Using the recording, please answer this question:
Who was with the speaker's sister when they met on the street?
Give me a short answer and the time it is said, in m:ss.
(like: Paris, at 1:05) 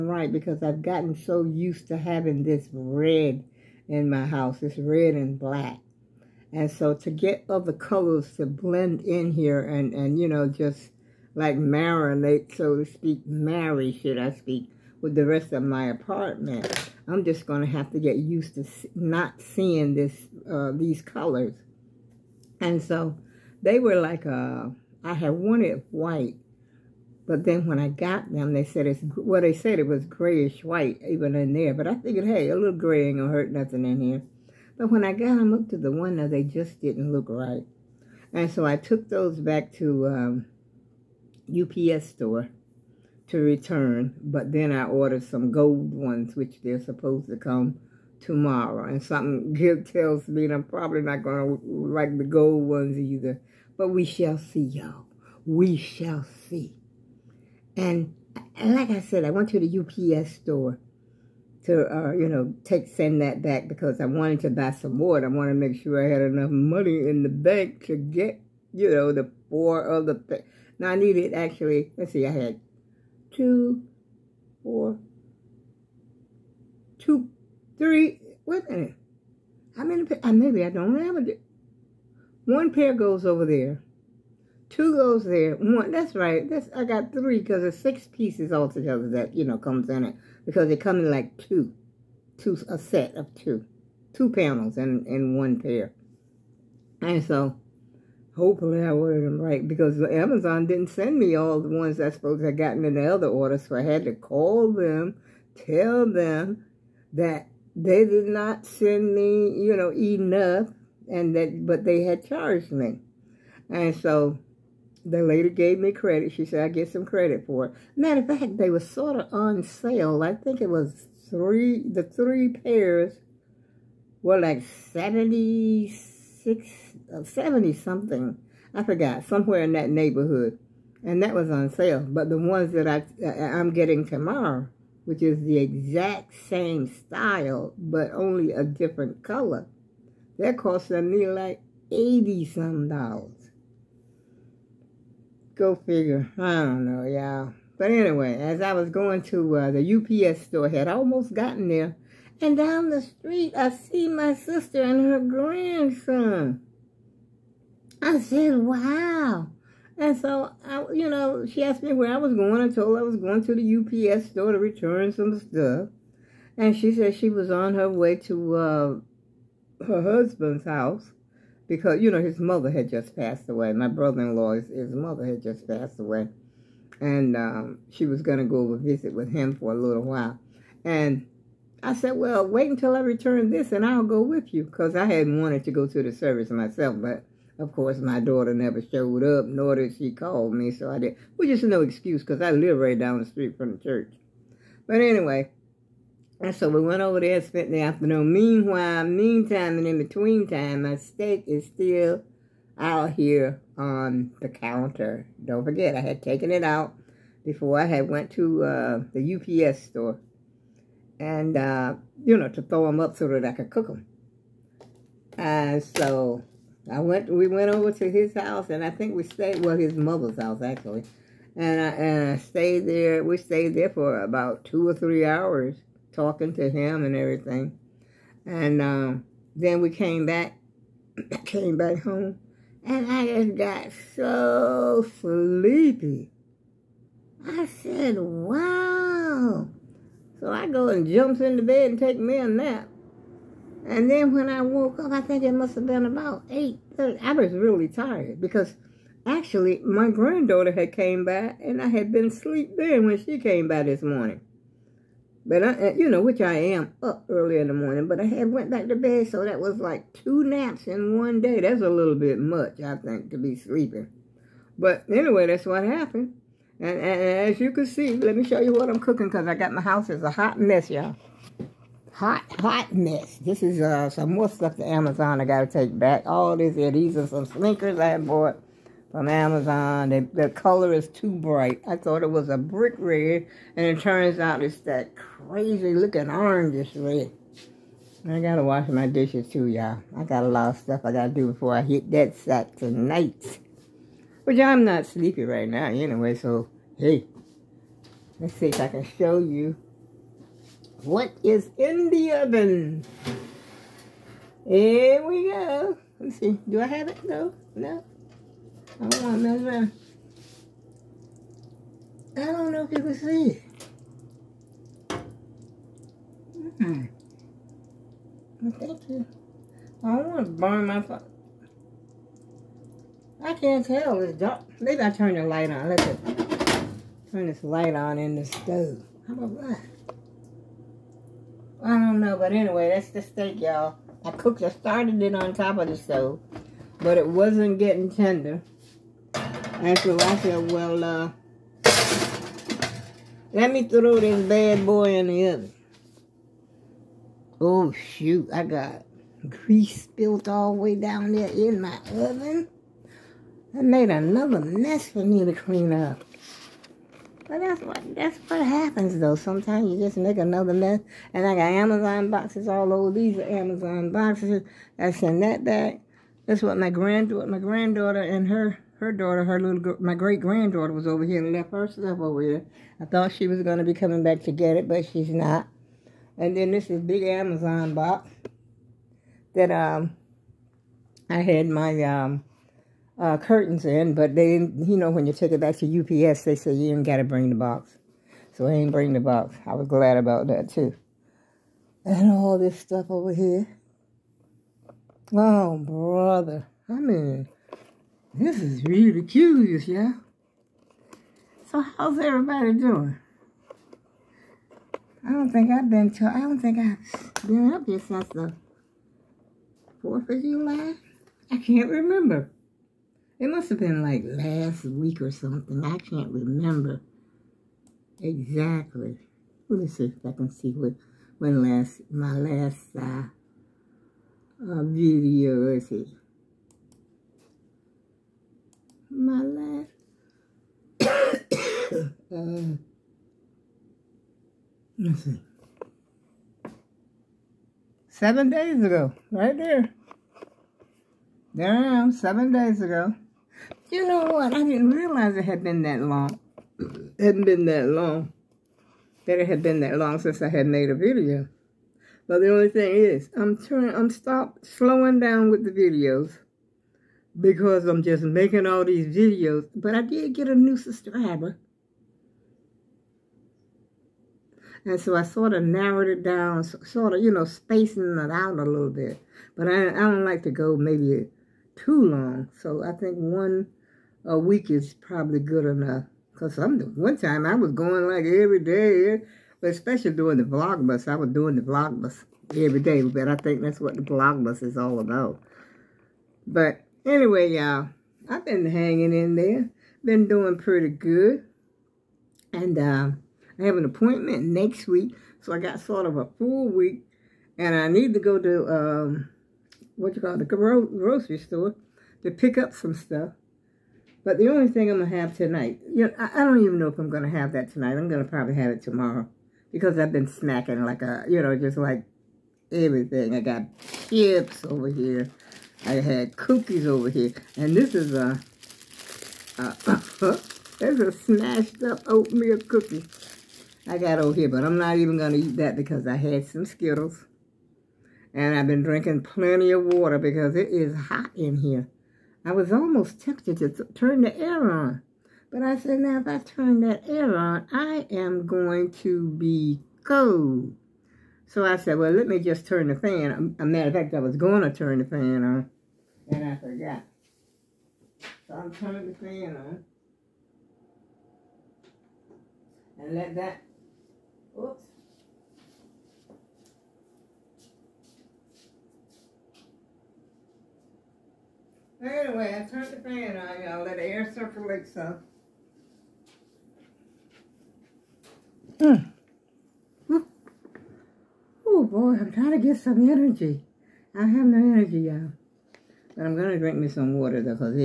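her grandson, at 2:35.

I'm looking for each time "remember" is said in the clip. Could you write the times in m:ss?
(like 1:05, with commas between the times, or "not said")
6:51, 6:56.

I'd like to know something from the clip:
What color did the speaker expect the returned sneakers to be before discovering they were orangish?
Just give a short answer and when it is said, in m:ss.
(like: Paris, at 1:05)
brick red, at 4:42.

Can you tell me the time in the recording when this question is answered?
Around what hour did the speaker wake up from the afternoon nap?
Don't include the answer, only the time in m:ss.
4:06.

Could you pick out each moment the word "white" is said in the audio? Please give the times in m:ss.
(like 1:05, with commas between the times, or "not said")
0:25, 0:30.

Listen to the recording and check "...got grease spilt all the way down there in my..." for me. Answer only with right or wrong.
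right.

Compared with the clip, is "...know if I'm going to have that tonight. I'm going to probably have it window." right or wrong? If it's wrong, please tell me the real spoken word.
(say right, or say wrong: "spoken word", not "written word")
wrong: "tomorrow", not "window".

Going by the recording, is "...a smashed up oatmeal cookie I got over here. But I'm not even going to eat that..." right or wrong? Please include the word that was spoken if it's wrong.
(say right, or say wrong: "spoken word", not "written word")
right.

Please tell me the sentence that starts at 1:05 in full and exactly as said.
And I wanted to make sure I had enough money in the bank to get, you know, the four other things.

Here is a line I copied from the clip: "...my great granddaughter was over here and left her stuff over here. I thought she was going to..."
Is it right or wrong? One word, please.
right.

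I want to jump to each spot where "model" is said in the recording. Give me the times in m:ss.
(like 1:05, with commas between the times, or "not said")
not said.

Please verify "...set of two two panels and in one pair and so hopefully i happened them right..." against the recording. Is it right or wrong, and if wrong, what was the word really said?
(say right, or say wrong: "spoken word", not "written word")
wrong: "ordered", not "happened".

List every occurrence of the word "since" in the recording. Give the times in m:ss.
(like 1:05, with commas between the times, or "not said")
6:47, 7:30.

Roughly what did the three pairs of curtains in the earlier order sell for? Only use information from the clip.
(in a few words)
70 something.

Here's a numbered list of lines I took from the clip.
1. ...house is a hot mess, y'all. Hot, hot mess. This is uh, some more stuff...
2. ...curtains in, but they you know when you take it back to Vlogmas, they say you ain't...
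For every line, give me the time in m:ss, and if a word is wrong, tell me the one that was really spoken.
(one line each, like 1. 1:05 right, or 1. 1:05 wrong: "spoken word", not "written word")
1. 4:29 right
2. 6:23 wrong: "UPS", not "Vlogmas".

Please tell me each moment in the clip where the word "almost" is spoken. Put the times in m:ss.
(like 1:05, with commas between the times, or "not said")
2:30, 8:52.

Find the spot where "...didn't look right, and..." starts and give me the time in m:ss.
0:36.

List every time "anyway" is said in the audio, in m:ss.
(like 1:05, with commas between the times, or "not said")
2:27, 3:15, 4:25, 4:55, 5:32, 8:07, 9:22.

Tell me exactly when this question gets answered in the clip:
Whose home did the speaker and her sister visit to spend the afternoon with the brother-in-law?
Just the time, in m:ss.
3:39.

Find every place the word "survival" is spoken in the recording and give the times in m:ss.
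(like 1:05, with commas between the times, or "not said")
not said.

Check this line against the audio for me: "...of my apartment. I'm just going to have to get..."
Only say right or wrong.
right.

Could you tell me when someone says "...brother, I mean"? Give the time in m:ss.
6:35.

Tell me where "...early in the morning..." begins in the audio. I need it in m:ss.
4:17.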